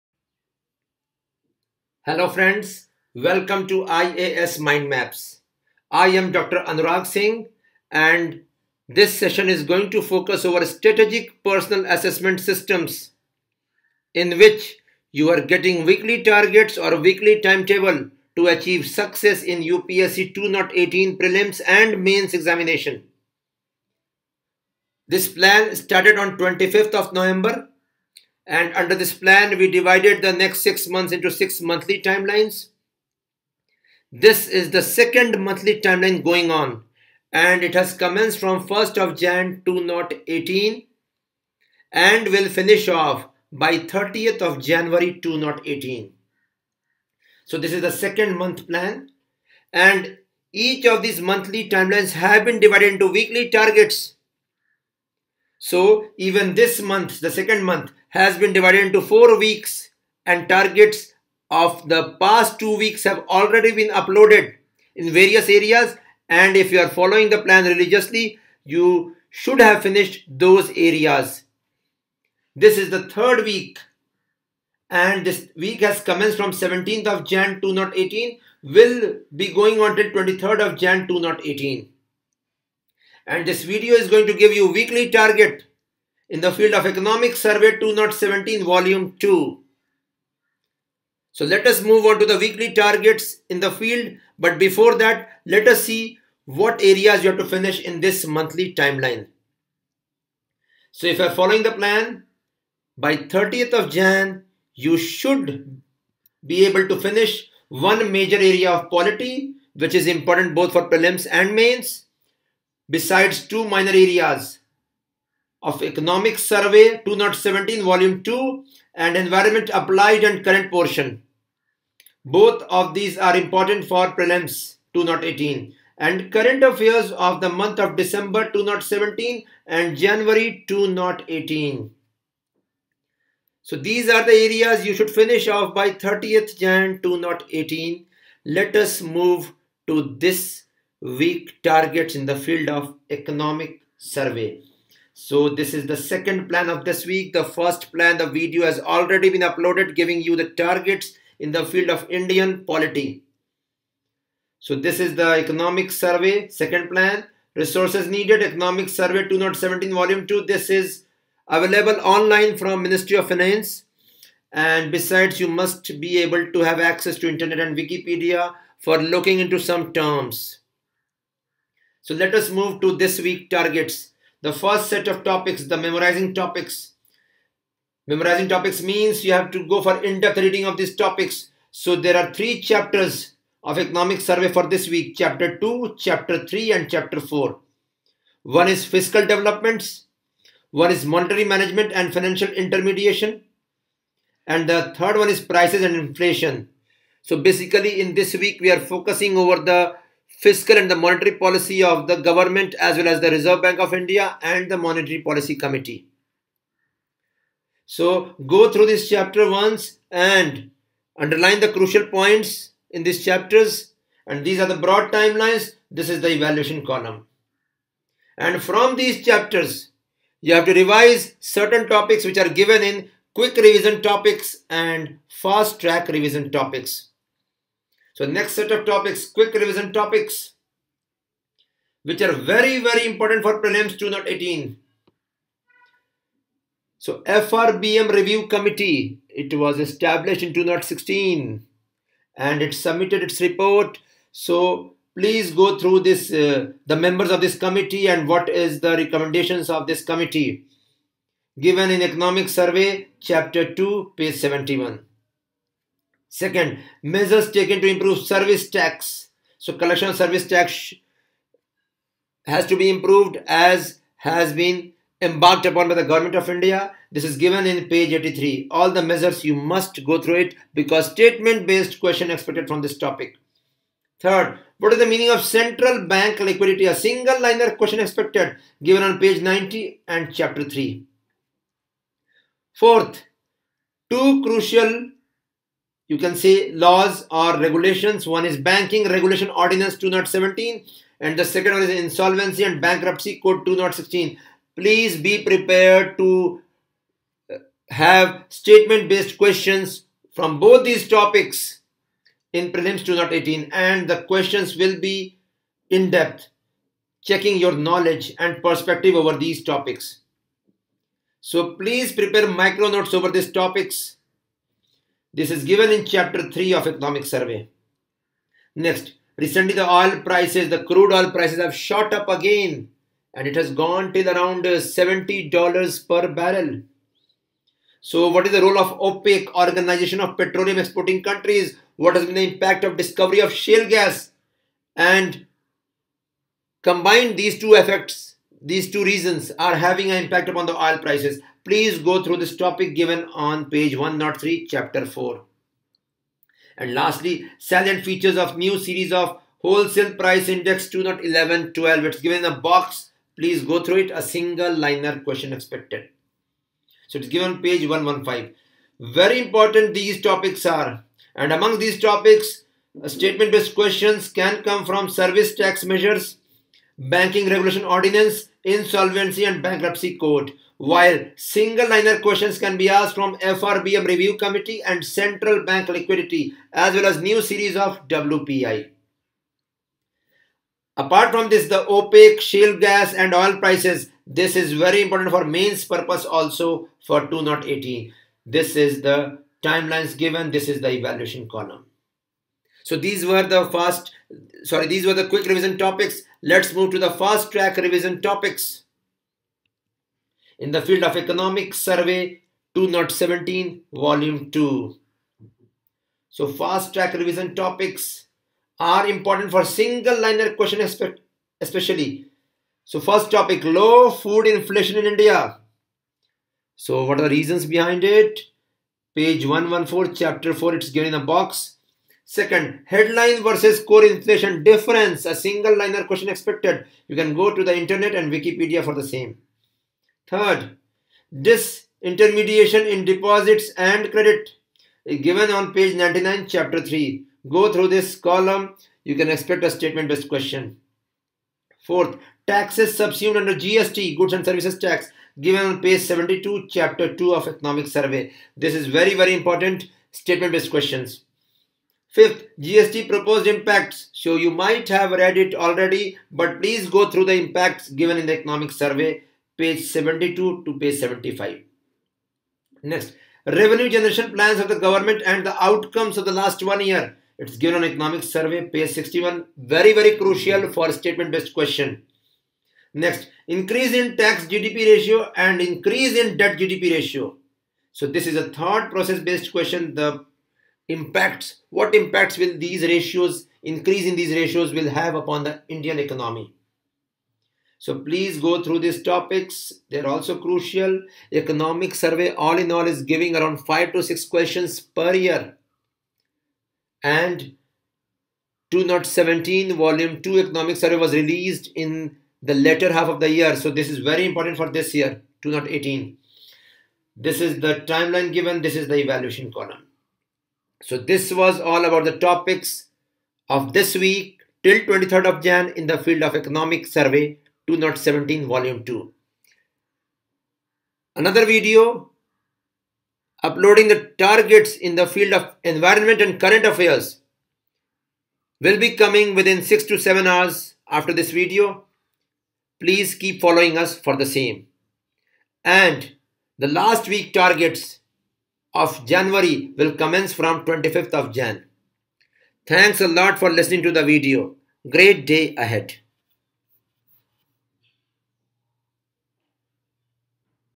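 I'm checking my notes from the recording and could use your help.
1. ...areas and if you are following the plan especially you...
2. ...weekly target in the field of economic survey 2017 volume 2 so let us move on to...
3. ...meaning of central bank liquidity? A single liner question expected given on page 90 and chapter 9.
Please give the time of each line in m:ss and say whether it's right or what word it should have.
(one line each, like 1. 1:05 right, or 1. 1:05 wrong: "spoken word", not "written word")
1. 1:05 wrong: "religiously", not "especially"
2. 1:24 right
3. 4:35 wrong: "3", not "9".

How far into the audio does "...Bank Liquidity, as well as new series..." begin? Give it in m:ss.
6:15.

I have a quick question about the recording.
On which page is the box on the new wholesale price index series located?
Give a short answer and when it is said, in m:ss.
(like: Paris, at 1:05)
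115, at 5:57.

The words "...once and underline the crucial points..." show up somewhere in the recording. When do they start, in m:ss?
3:29.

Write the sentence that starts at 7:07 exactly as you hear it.
You can go to the internet and Wikipedia for the same.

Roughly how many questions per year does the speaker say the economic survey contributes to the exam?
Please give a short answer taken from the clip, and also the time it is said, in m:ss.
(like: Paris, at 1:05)
5 to 6, at 8:13.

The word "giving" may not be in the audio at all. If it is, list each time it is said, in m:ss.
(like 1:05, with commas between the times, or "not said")
2:29, 8:13.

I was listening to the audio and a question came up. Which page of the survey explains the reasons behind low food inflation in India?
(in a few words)
114.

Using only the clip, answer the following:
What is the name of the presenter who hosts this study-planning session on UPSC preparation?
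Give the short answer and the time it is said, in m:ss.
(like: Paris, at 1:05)
Dr. Anurag Singh, at 0:06.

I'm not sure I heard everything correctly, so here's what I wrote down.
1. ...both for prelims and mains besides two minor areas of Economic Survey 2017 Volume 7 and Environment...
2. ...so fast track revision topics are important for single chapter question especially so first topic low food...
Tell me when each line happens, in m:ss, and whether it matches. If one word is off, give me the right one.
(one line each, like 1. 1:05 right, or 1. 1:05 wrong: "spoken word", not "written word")
1. 1:50 wrong: "2", not "7"
2. 6:46 wrong: "liner", not "chapter".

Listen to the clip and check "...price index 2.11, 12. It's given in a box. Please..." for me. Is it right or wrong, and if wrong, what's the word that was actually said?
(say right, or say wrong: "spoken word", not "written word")
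right.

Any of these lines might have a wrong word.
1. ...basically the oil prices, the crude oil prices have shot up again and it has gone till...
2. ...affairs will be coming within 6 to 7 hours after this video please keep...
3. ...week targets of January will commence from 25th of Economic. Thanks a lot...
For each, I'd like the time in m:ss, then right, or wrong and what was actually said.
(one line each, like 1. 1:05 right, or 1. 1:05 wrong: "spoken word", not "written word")
1. 5:19 wrong: "recently", not "basically"
2. 8:46 right
3. 8:57 wrong: "Jan", not "Economic".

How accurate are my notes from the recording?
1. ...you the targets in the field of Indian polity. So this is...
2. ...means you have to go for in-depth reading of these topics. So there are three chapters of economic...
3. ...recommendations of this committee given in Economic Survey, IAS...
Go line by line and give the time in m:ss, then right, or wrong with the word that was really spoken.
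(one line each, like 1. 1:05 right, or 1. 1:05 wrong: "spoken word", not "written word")
1. 2:30 right
2. 2:58 right
3. 4:08 wrong: "Chapter", not "IAS".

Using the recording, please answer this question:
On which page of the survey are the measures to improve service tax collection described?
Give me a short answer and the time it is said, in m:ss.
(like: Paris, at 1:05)
83, at 4:28.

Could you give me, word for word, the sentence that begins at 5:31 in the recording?
What has been the impact of discovery of shale gas?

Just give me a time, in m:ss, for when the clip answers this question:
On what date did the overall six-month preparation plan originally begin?
0:26.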